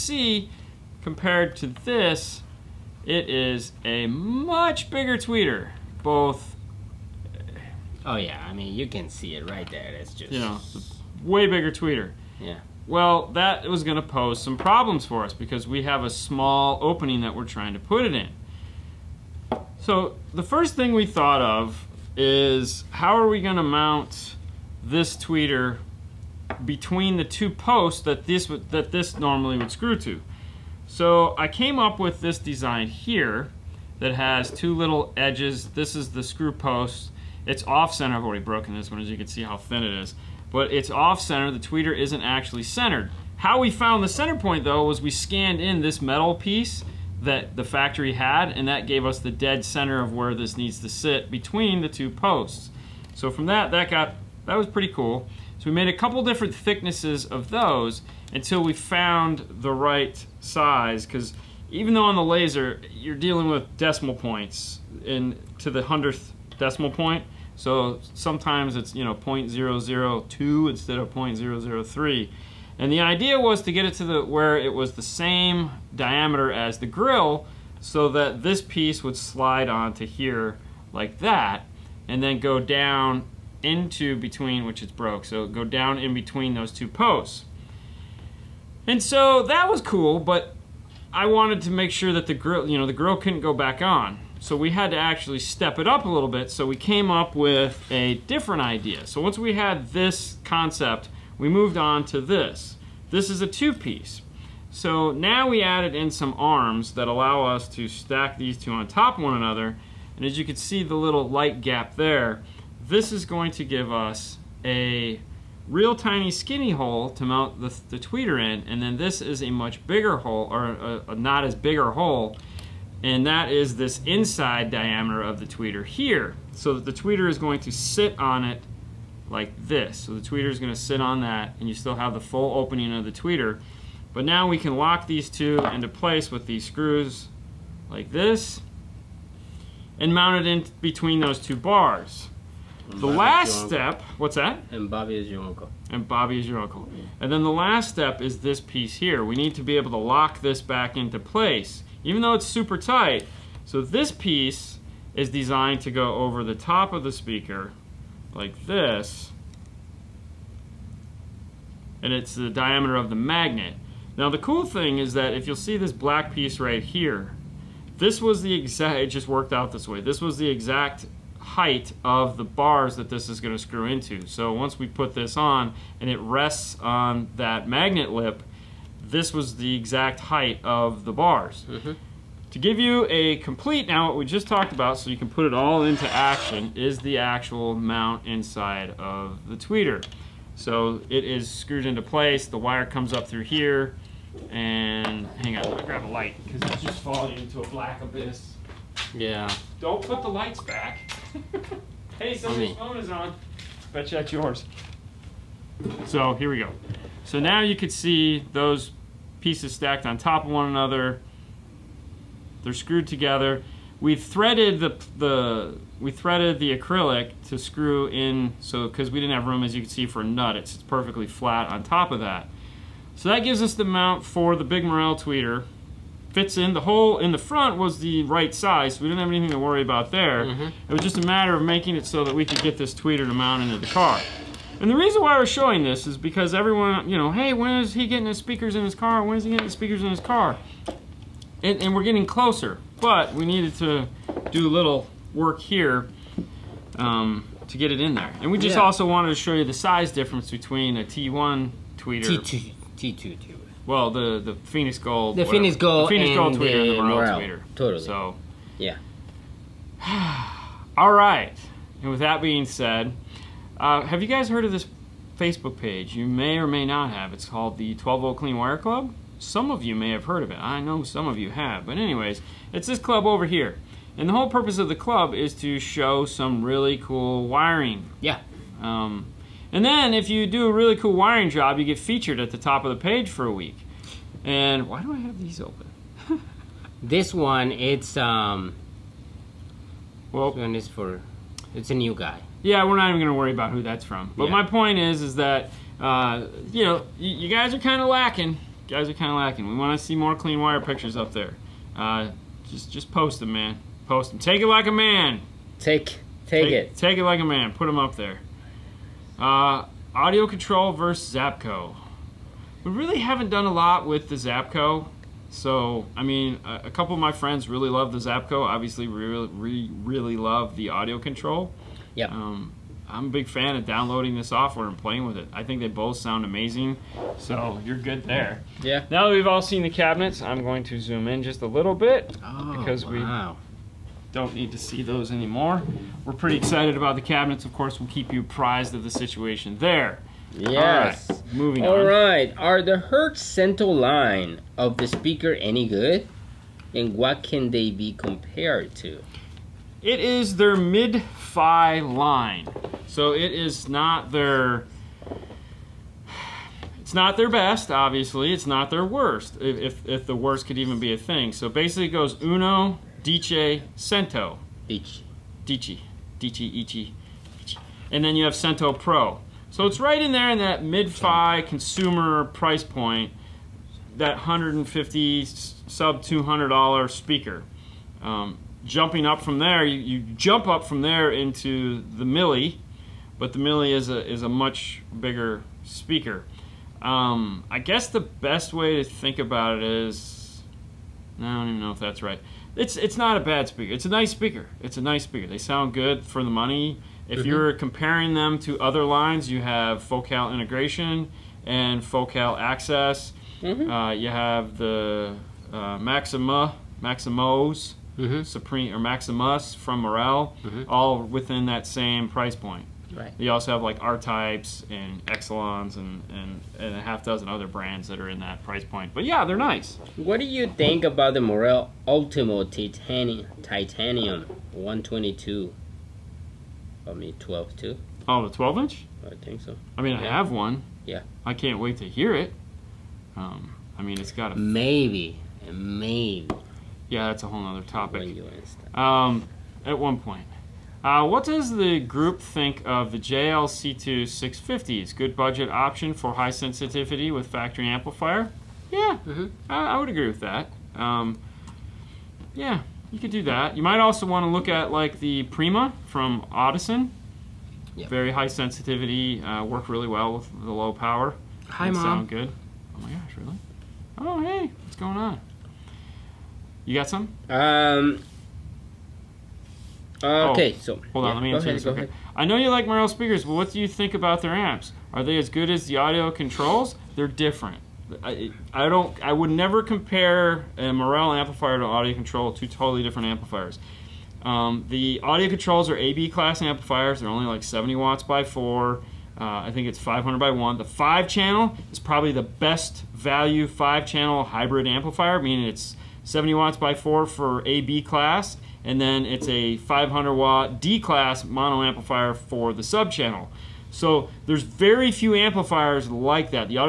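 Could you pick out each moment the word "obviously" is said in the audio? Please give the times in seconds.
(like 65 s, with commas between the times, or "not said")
318 s, 357 s.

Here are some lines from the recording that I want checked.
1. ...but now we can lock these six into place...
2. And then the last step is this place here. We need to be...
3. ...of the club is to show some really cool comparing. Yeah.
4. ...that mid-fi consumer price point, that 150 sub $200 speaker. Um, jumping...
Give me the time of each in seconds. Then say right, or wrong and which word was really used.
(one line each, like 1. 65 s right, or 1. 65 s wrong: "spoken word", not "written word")
1. 134 s wrong: "two", not "six"
2. 147 s wrong: "piece", not "place"
3. 274 s wrong: "wiring", not "comparing"
4. 370 s right.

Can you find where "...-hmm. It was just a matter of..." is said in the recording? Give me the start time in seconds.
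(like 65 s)
230 s.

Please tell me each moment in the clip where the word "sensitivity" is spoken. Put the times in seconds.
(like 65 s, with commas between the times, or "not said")
446 s, 458 s.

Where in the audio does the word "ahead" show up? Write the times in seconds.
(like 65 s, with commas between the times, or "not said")
471 s.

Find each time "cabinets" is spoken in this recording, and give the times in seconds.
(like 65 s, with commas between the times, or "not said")
329 s, 337 s.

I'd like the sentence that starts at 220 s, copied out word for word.
It's, it's perfectly flat on top of that.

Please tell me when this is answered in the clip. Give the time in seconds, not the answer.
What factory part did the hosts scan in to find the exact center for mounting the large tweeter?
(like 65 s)
46 s.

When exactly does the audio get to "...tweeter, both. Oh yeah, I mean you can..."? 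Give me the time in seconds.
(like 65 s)
5 s.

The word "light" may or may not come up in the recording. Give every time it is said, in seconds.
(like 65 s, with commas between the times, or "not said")
111 s, 196 s, 200 s.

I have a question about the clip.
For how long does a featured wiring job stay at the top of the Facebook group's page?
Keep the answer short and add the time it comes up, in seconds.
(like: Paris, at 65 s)
a week, at 283 s.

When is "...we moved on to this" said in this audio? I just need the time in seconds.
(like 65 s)
101 s.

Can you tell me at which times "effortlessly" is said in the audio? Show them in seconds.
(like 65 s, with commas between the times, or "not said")
not said.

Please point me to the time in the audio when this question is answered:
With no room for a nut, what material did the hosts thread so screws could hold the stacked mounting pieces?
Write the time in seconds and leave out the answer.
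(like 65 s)
216 s.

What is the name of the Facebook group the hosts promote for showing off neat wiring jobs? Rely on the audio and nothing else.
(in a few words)
12 Volt Clean Wire Club.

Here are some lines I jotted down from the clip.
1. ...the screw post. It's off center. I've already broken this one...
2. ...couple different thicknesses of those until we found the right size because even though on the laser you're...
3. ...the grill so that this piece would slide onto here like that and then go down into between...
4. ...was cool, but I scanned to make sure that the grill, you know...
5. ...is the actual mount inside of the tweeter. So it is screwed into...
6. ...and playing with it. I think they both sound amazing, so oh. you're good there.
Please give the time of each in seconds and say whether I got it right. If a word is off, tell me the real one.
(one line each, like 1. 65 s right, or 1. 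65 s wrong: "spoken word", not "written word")
1. 36 s right
2. 55 s right
3. 76 s right
4. 89 s wrong: "wanted", not "scanned"
5. 186 s right
6. 324 s right.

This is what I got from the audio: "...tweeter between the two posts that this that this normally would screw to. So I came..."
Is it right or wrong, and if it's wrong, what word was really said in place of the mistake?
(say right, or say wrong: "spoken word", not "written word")
right.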